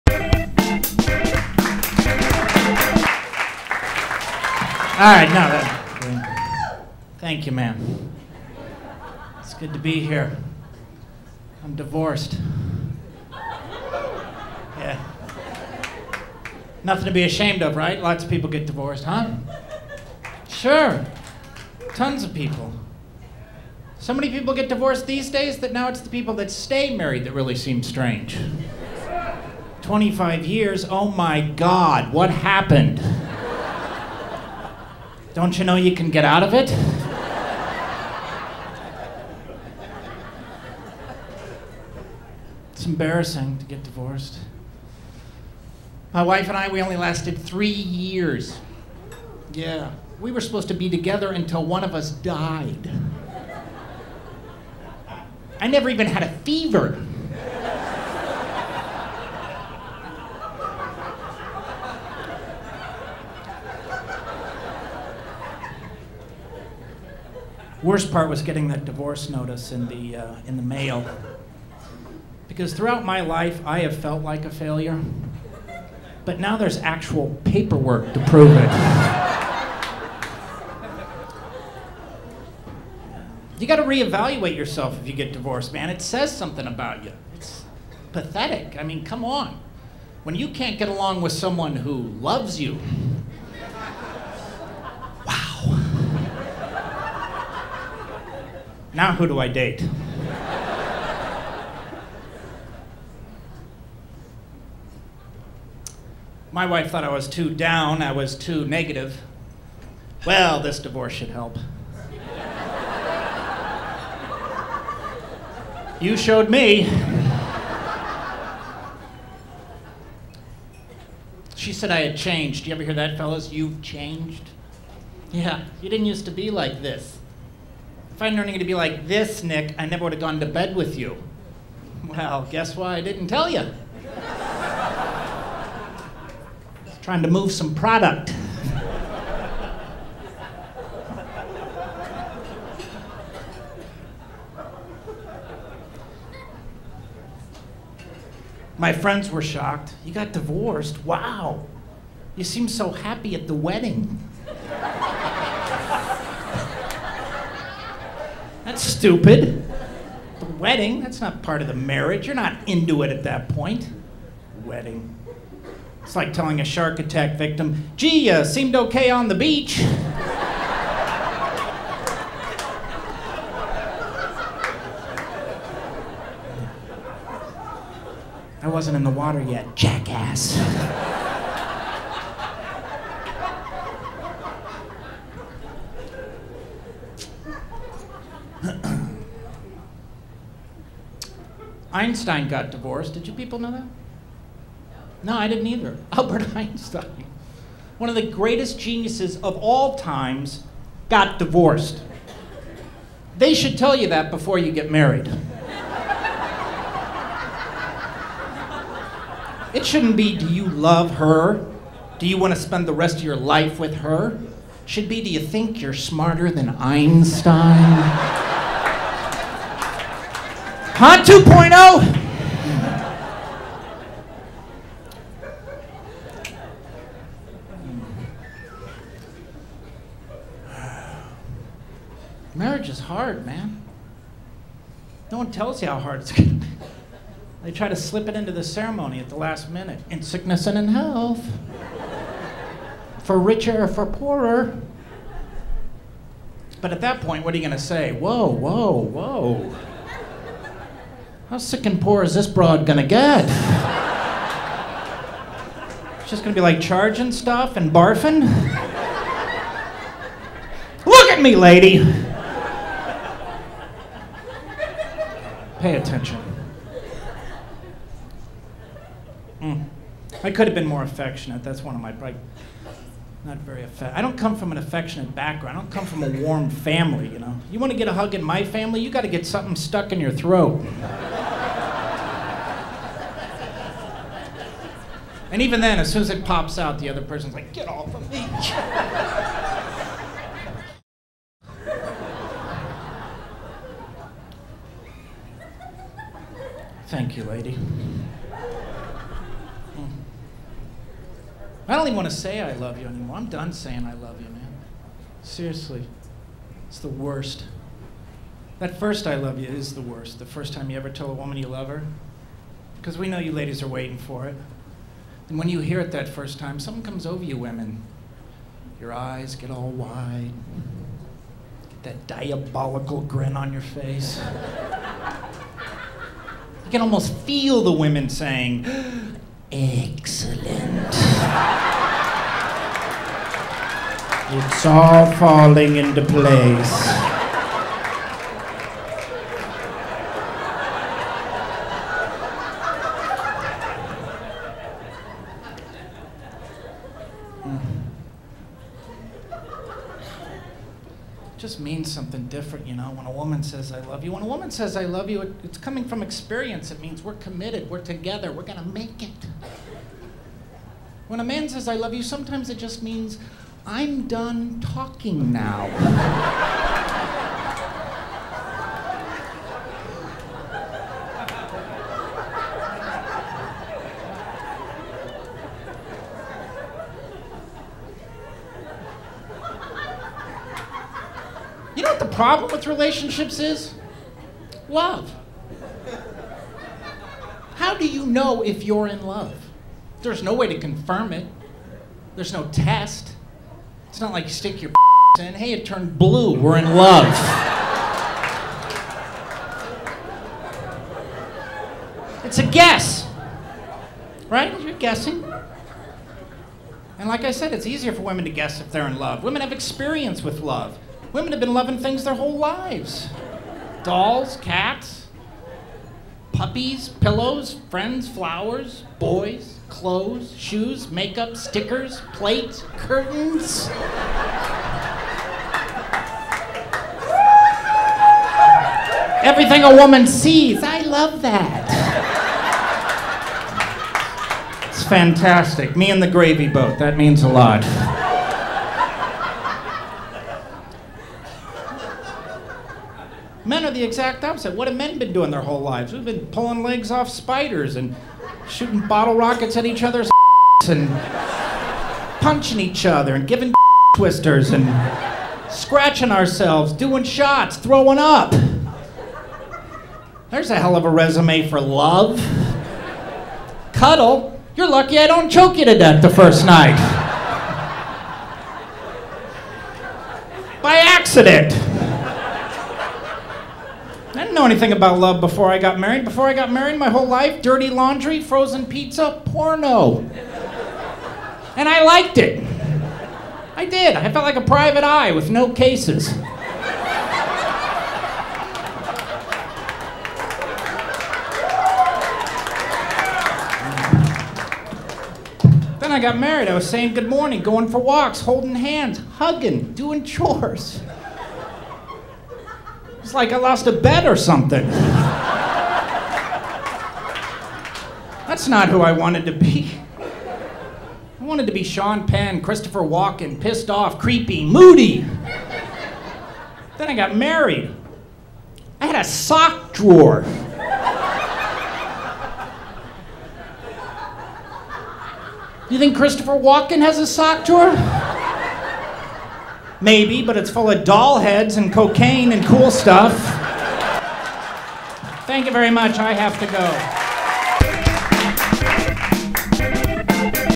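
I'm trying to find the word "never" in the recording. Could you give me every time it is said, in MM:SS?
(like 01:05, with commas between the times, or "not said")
00:55, 02:09.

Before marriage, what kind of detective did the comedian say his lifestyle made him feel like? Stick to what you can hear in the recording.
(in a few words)
Private eye.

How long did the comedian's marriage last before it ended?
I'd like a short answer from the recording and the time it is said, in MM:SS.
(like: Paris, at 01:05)
3 years, at 00:47.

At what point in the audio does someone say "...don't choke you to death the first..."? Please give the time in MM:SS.
07:45.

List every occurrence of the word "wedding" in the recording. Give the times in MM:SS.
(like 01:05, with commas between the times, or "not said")
02:33, 02:40, 02:44.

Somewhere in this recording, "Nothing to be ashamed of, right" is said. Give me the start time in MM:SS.
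00:16.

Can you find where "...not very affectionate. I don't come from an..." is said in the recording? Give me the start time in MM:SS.
04:33.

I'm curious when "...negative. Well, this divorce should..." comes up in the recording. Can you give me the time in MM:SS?
01:48.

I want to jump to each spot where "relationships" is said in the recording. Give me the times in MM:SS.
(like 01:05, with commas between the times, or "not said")
06:22.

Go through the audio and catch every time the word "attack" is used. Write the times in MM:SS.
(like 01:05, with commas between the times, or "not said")
02:46.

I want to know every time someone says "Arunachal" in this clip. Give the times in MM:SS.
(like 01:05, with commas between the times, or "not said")
not said.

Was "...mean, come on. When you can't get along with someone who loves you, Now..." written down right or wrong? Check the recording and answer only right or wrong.
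right.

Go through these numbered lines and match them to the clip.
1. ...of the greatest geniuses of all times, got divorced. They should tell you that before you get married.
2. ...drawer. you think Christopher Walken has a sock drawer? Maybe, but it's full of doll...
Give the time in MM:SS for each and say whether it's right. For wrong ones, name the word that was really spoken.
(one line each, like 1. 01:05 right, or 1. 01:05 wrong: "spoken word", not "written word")
1. 03:18 right
2. 08:39 right.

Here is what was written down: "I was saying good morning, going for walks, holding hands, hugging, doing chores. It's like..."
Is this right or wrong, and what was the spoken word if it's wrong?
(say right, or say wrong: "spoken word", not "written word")
right.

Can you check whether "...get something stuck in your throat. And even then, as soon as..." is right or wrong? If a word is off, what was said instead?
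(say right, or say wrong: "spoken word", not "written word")
right.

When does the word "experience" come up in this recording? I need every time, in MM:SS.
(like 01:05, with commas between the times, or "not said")
05:56, 06:49.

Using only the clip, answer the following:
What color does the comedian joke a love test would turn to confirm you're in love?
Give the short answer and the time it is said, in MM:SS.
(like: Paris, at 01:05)
Blue, at 06:36.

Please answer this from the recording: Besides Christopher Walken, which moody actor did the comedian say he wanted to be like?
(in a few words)
Sean Penn.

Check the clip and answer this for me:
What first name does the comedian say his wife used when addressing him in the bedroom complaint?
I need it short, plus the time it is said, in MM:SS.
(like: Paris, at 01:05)
Nick, at 02:09.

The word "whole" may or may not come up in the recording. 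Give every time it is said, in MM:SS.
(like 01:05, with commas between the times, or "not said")
06:52, 07:25, 07:57.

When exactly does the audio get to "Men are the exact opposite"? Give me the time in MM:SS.
07:23.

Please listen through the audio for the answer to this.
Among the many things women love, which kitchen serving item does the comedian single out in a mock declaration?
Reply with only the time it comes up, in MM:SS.
07:16.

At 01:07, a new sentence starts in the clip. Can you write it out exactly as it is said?
Worst part was getting that divorce notice in the, uh, in the mail.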